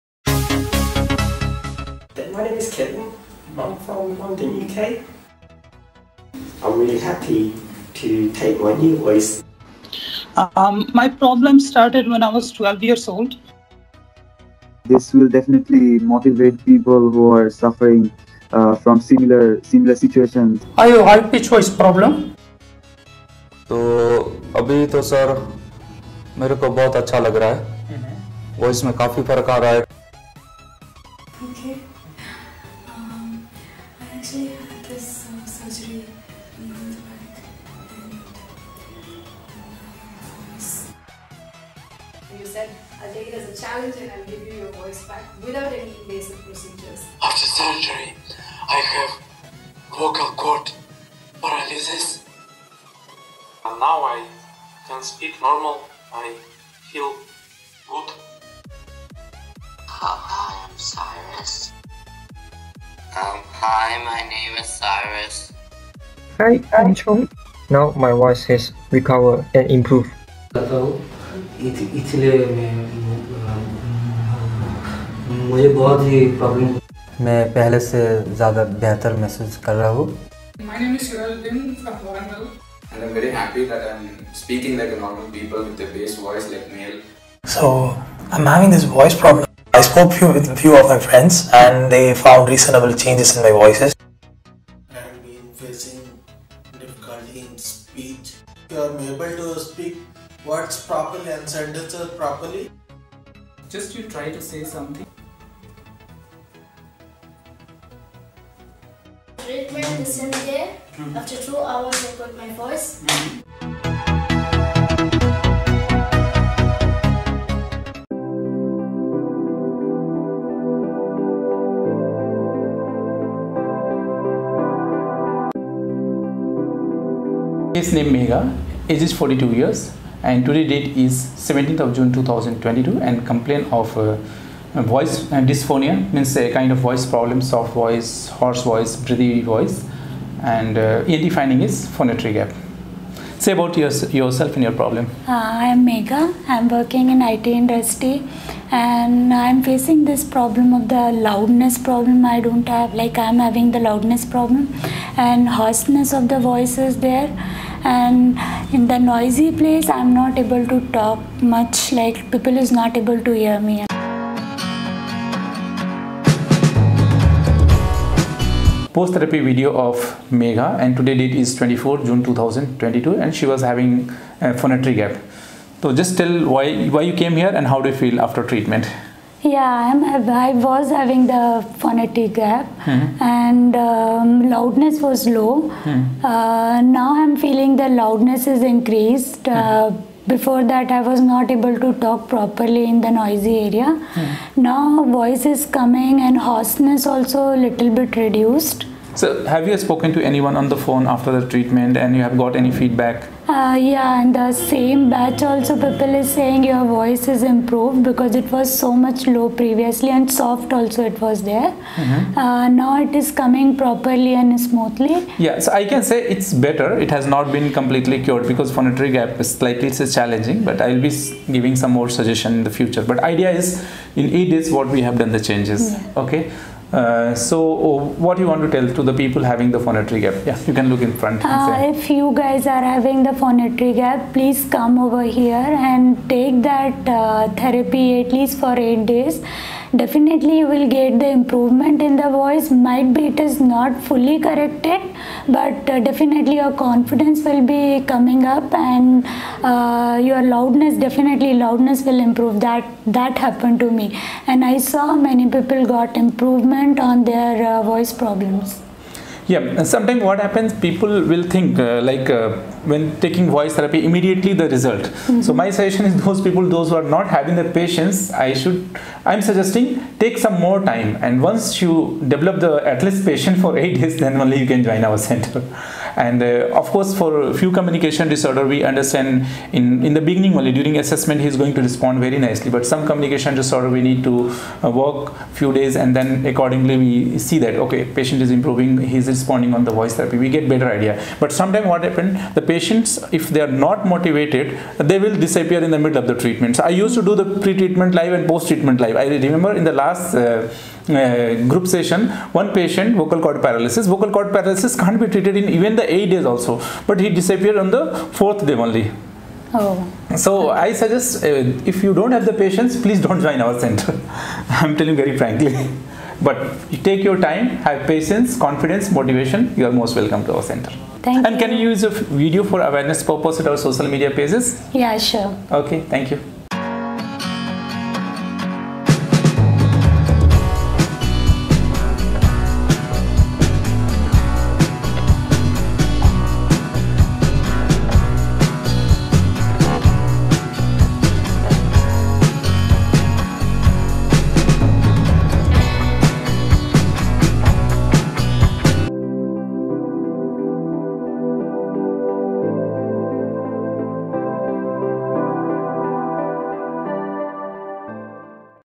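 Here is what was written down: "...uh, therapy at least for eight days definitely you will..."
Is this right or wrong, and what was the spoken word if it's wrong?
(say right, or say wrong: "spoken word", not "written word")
right.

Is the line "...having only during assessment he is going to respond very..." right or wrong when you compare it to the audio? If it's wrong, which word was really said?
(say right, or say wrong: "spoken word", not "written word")
wrong: "beginning", not "having".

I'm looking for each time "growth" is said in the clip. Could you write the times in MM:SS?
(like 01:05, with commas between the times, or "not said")
not said.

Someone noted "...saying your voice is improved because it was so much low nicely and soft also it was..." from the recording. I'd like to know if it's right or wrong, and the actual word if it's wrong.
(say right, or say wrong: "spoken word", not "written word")
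wrong: "previously", not "nicely".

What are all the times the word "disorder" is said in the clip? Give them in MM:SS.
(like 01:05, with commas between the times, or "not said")
04:38, 04:43.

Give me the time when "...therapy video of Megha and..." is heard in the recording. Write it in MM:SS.
02:49.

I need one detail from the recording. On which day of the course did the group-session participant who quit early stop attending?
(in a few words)
4th day.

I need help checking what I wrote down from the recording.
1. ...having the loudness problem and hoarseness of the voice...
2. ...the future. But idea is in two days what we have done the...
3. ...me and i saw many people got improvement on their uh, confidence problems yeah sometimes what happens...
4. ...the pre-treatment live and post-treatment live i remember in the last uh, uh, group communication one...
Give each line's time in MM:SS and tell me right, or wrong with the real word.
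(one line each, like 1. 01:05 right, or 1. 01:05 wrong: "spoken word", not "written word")
1. 02:33 right
2. 03:42 wrong: "eight", not "two"
3. 04:13 wrong: "voice", not "confidence"
4. 04:57 wrong: "session", not "communication".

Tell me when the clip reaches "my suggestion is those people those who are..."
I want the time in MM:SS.
04:25.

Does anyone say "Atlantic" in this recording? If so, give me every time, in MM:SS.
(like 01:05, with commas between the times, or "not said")
not said.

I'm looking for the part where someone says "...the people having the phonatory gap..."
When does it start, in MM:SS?
03:49.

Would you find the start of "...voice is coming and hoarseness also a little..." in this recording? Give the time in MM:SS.
03:15.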